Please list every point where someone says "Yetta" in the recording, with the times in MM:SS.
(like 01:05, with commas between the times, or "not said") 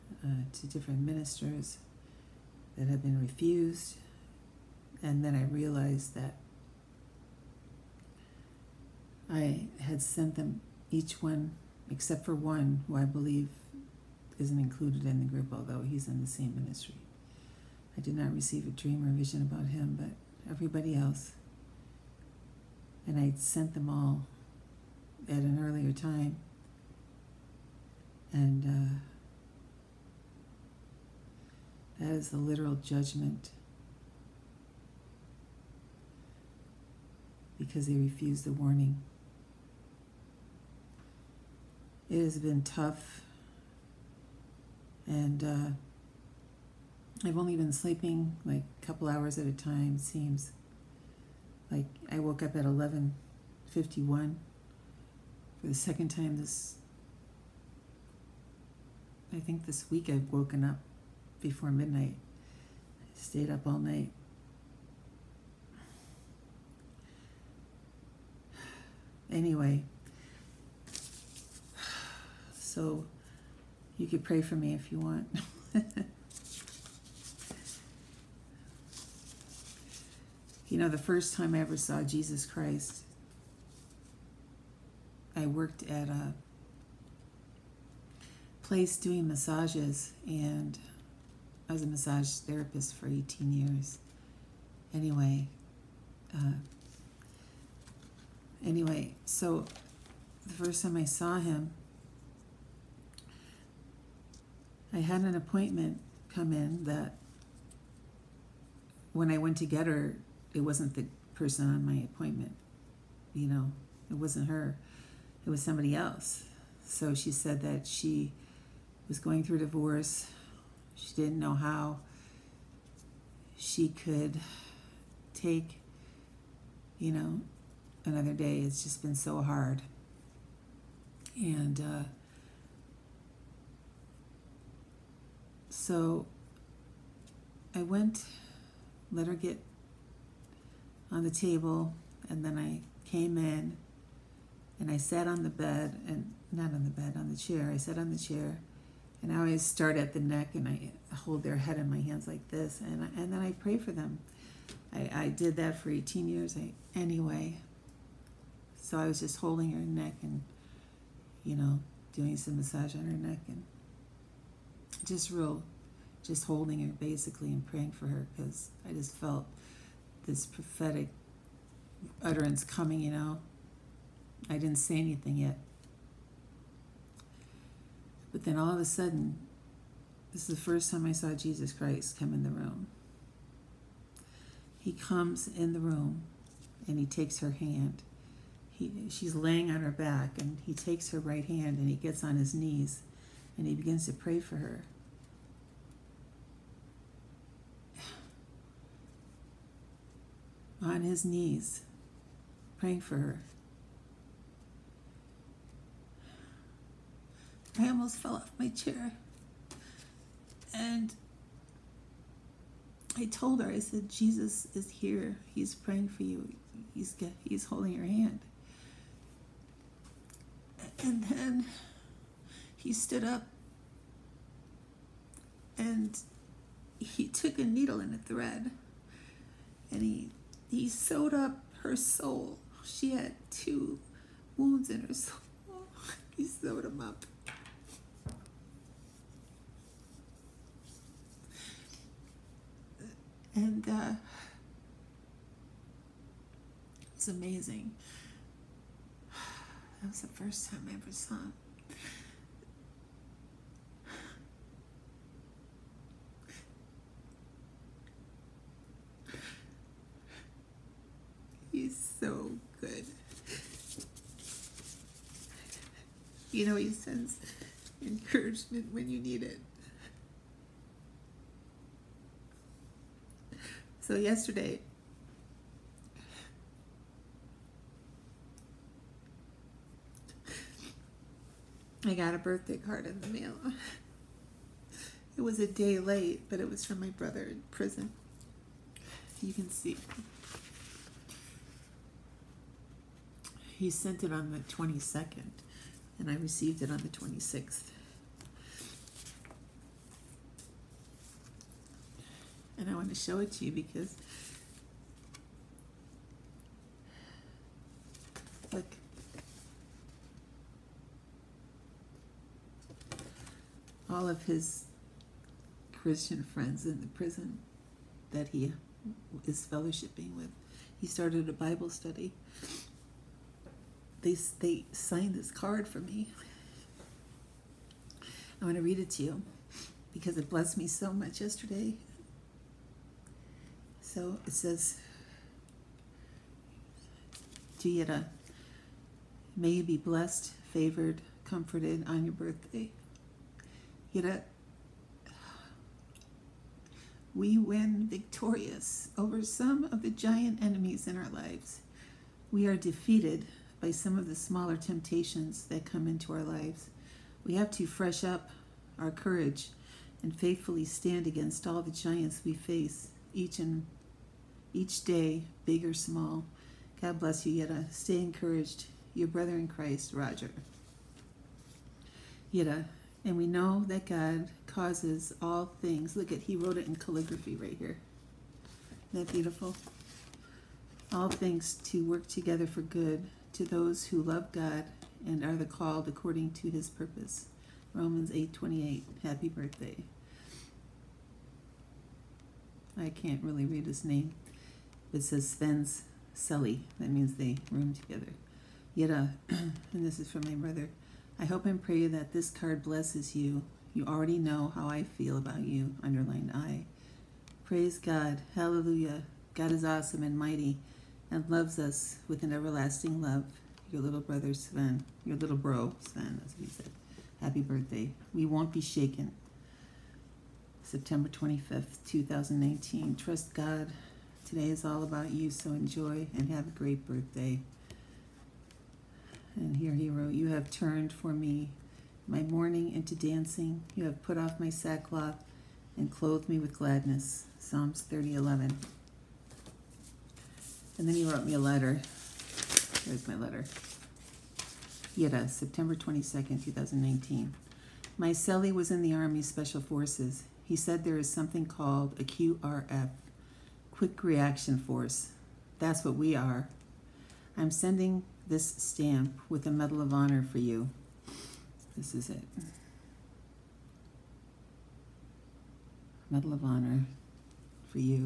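06:07, 06:12.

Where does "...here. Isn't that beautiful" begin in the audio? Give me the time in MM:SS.
06:17.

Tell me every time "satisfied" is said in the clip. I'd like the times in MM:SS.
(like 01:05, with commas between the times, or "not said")
not said.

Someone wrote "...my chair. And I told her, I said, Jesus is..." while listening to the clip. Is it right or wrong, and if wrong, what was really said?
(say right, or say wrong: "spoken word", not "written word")
right.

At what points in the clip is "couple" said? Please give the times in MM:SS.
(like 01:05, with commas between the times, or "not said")
00:48.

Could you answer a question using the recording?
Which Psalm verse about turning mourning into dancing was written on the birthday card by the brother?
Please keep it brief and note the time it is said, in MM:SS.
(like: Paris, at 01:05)
Psalms 30:11, at 07:17.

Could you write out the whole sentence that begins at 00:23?
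And I sent them all at an earlier time.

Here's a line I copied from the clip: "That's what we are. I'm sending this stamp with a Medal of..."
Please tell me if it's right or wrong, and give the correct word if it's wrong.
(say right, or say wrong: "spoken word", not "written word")
right.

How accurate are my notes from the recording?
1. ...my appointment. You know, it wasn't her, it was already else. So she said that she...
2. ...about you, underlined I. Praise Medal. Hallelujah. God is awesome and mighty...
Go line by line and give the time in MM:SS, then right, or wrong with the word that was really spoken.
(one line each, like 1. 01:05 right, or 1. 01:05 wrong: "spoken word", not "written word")
1. 01:51 wrong: "somebody", not "already"
2. 06:45 wrong: "God", not "Medal".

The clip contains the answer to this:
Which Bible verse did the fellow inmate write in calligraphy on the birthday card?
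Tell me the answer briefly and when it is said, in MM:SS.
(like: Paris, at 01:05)
Romans 8:28, at 06:27.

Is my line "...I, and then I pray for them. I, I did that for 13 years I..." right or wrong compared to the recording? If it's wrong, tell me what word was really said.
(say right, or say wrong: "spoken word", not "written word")
wrong: "18", not "13".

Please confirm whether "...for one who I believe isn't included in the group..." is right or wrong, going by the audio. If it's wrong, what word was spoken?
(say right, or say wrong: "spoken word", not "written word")
right.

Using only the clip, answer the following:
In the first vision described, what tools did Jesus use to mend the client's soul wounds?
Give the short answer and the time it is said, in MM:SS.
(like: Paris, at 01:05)
a needle and a thread, at 03:47.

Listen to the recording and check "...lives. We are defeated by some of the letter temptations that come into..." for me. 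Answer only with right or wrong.
wrong.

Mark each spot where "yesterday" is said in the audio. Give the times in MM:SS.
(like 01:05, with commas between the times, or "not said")
04:34, 05:31.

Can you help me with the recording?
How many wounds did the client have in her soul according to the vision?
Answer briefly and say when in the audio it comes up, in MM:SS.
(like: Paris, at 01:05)
2, at 03:53.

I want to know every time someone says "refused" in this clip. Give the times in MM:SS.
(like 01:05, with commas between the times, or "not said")
00:03, 00:37.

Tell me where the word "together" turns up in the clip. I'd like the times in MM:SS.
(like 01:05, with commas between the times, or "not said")
06:22, 06:37.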